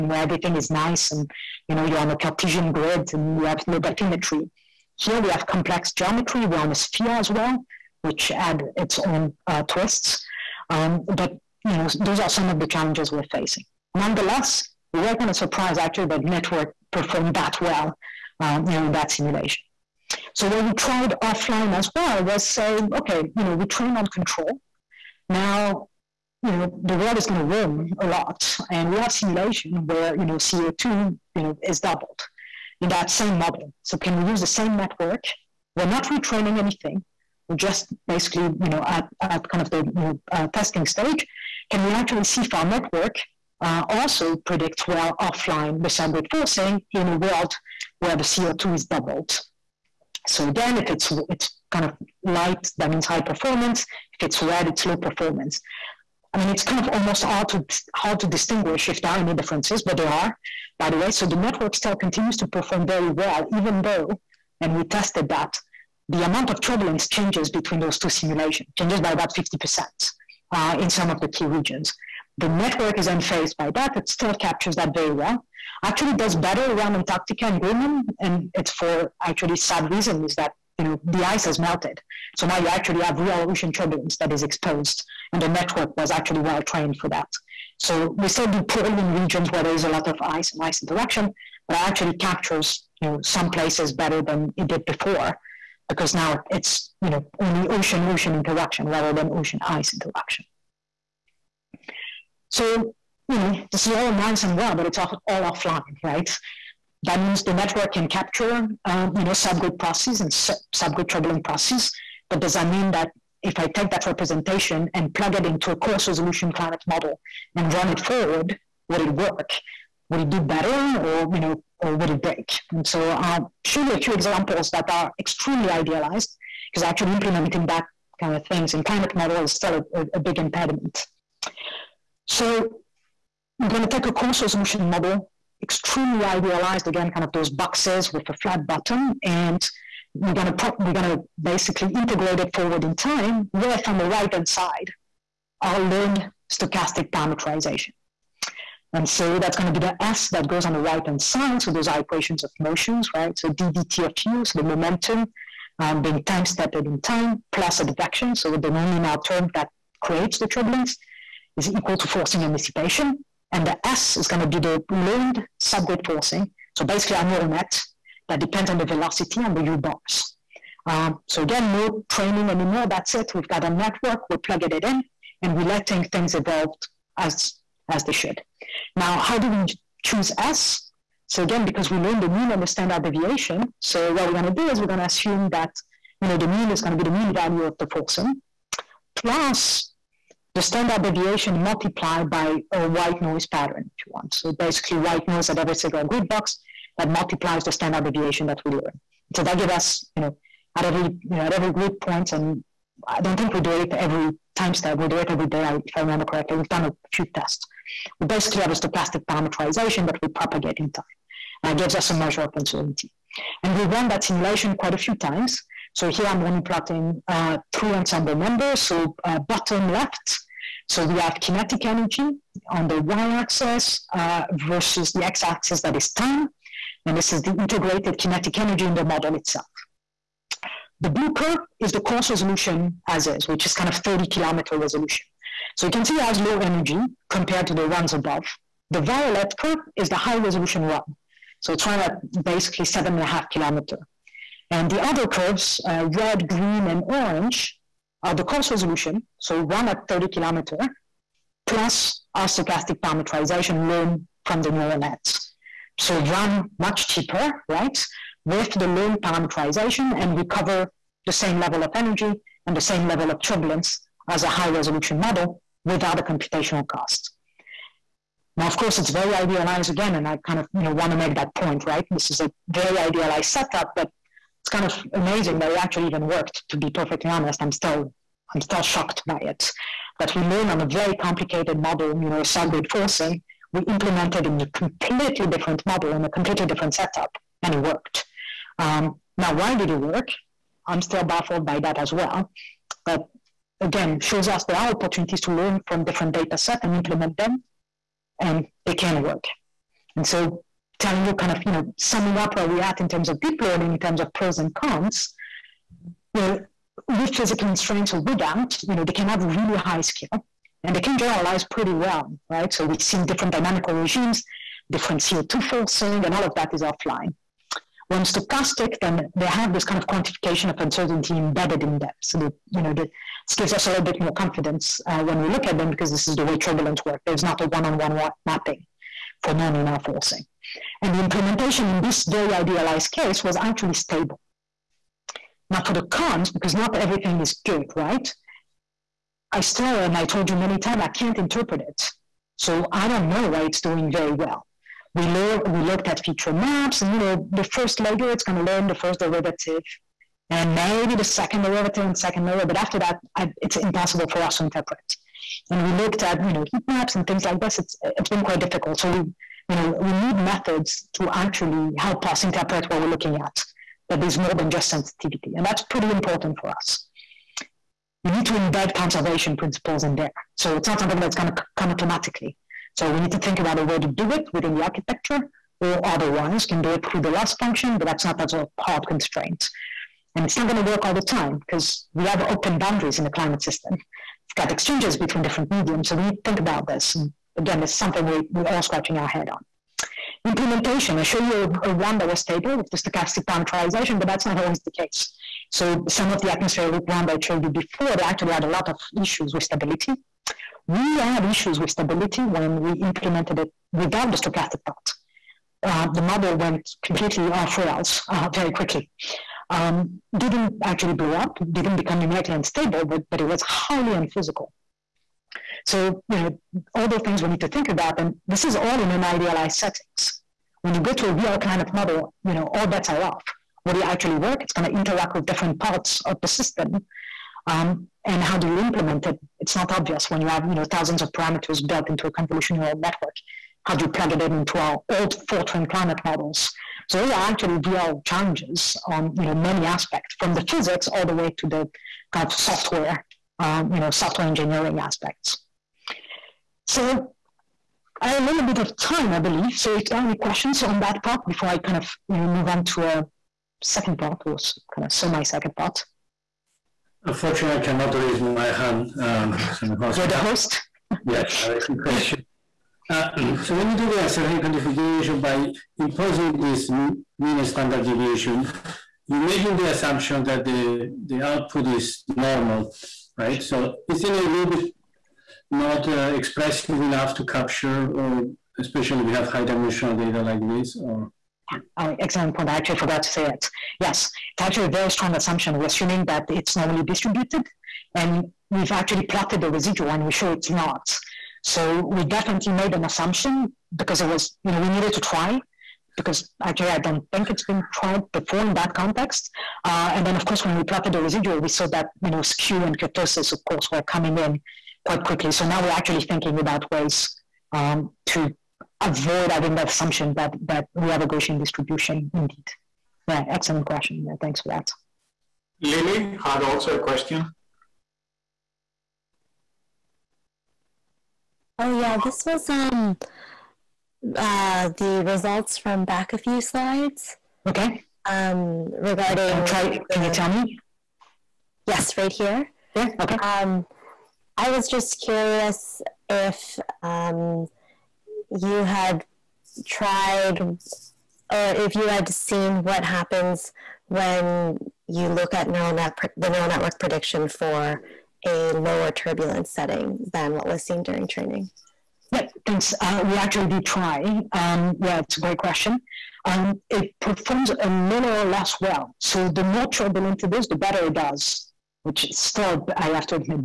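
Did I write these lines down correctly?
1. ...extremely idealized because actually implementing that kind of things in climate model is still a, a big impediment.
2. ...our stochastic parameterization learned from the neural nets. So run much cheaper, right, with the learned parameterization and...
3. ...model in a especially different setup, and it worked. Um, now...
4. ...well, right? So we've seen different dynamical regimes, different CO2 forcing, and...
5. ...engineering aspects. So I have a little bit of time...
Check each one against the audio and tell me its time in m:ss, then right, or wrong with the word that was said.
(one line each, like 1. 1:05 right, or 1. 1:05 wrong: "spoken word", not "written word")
1. 2:05 right
2. 4:12 right
3. 4:45 wrong: "completely", not "especially"
4. 5:11 right
5. 7:24 right.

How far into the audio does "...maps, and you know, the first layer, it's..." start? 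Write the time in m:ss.
5:46.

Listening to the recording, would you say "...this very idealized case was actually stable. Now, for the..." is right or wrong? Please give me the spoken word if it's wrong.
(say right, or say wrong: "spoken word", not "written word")
right.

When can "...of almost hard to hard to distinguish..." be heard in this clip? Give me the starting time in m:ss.
0:56.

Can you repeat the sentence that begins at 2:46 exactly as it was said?
So basically our neural net that depends on the velocity on the U bars.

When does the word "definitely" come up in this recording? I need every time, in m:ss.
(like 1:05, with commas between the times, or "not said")
8:12.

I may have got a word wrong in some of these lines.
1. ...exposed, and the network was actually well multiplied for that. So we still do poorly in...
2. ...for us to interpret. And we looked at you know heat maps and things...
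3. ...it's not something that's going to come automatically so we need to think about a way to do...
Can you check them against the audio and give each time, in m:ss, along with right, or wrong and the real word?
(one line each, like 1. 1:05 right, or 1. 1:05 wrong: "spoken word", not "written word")
1. 1:24 wrong: "trained", not "multiplied"
2. 5:54 right
3. 6:10 right.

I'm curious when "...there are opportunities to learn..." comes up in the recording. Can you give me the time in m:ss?
4:54.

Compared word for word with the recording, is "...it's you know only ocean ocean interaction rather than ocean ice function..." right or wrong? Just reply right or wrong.
wrong.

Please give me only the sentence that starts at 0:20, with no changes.
So what we tried offline as well was saying, okay, you know, we train on control.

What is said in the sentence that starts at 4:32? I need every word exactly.
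This is a very idealized setup, but kind of amazing that it actually even worked.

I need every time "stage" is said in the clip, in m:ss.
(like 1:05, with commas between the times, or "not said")
0:40.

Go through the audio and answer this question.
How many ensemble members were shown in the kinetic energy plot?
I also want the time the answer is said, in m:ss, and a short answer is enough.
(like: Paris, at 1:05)
3, at 3:37.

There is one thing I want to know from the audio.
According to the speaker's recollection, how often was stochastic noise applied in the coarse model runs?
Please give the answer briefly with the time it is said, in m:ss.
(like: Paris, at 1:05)
every day, at 3:25.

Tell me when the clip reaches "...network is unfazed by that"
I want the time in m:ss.
1:12.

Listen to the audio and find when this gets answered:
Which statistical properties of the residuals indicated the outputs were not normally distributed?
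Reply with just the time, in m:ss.
8:22.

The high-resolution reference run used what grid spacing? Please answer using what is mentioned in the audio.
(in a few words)
7.5 kilometers.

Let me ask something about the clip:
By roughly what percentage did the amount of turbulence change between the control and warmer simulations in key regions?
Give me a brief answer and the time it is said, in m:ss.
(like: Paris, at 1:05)
50%, at 1:09.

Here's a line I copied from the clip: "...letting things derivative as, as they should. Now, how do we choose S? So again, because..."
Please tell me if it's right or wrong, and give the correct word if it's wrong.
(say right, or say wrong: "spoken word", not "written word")
wrong: "evolve", not "derivative".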